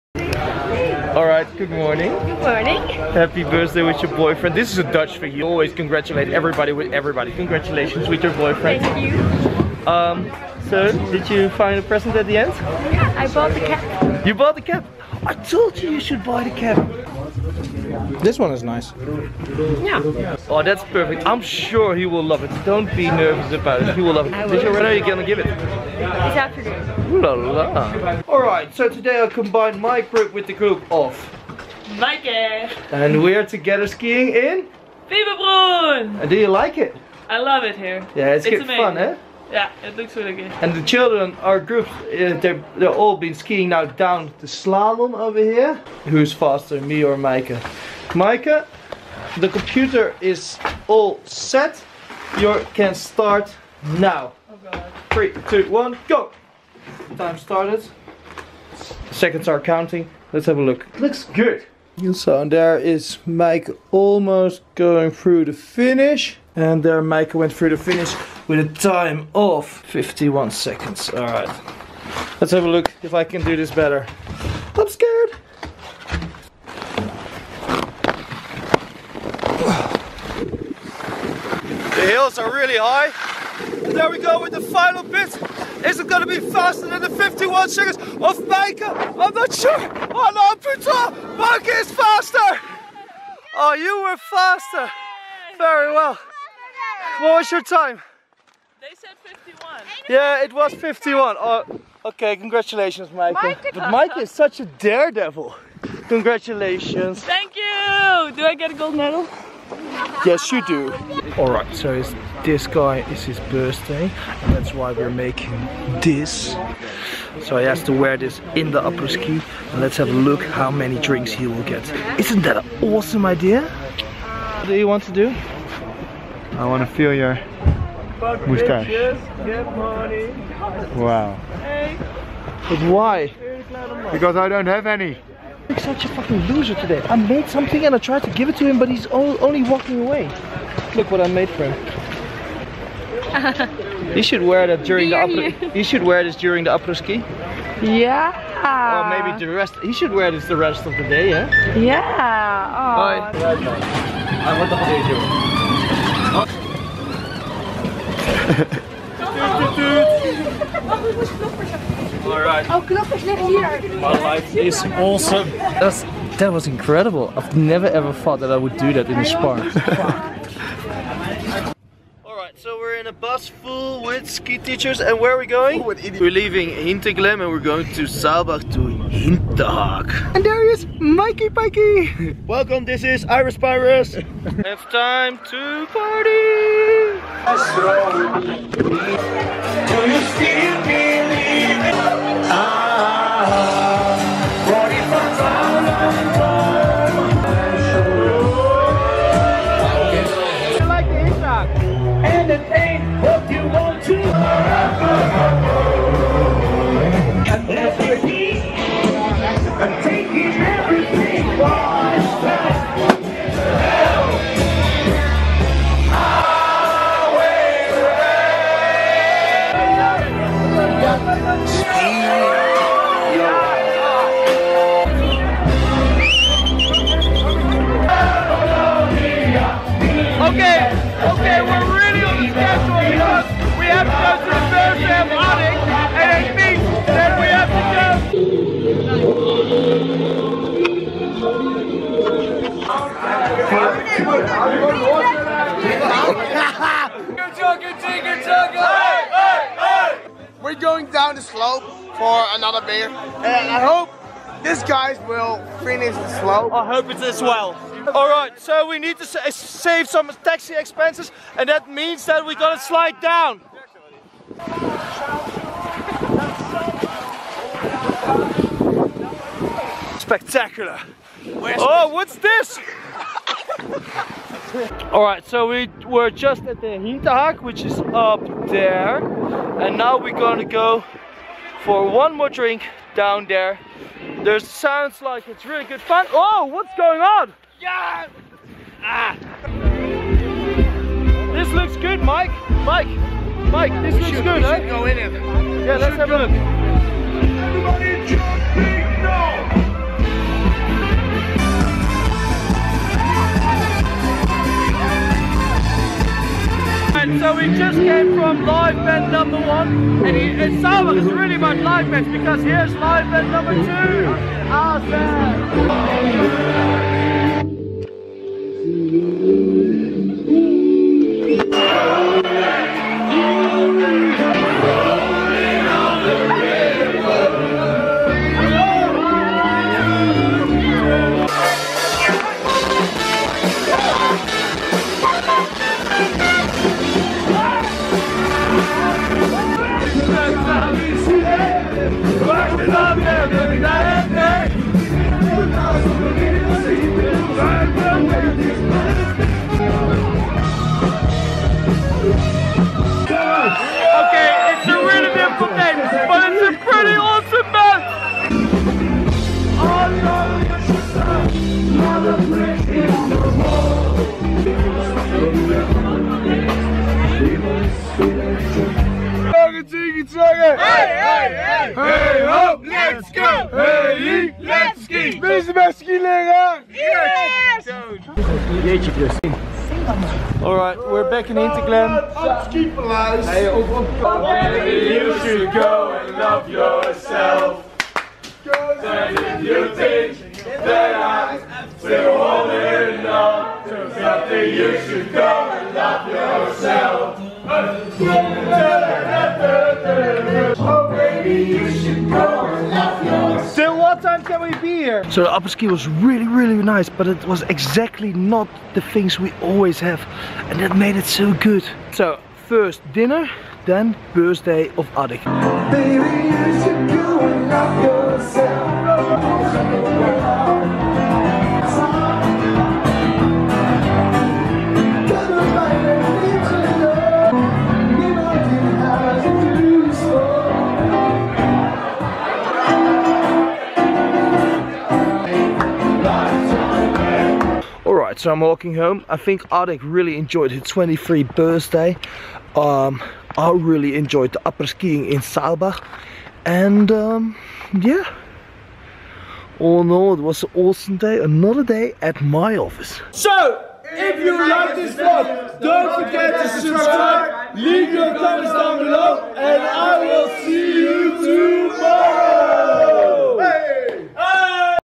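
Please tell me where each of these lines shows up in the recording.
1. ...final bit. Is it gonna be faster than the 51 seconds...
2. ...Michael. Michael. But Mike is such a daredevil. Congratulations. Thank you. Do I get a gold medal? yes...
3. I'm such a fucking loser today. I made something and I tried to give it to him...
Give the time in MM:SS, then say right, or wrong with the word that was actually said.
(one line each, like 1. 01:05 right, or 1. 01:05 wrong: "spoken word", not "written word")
1. 01:24 right
2. 01:43 right
3. 02:15 right.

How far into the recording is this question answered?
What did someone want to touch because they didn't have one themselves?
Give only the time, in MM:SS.
02:08.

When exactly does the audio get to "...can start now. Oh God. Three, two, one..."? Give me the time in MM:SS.
00:52.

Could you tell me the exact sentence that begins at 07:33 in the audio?
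So, if you like this vlog, don't forget to subscribe, leave your comments down below, and I will see you tomorrow!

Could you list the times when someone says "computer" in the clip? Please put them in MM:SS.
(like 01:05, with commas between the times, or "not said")
00:49.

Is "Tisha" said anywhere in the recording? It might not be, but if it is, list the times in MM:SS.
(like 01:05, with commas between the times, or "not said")
00:24.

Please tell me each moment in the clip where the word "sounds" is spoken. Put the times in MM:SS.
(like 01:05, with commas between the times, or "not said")
04:44.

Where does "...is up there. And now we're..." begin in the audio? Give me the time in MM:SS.
04:37.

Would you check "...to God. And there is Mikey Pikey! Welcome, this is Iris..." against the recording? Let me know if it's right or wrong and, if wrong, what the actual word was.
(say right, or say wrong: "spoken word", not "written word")
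wrong: "Hinterhag", not "God".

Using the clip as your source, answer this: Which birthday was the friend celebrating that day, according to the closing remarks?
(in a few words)
23rd.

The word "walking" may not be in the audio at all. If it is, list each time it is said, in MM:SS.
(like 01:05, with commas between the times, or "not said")
02:19, 07:18.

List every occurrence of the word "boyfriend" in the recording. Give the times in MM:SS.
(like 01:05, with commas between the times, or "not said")
00:04, 00:08.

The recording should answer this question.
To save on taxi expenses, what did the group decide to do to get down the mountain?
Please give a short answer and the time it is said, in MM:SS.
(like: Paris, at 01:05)
Slide down, at 04:22.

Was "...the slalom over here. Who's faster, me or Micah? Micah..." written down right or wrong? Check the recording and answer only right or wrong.
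right.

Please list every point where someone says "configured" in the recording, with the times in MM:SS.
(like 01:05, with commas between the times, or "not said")
not said.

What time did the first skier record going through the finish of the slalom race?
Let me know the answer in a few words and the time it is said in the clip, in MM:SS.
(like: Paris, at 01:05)
51 seconds, at 01:08.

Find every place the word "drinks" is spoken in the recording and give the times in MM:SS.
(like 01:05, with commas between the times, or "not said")
02:00, 04:42.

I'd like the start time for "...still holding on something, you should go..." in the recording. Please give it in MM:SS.
06:31.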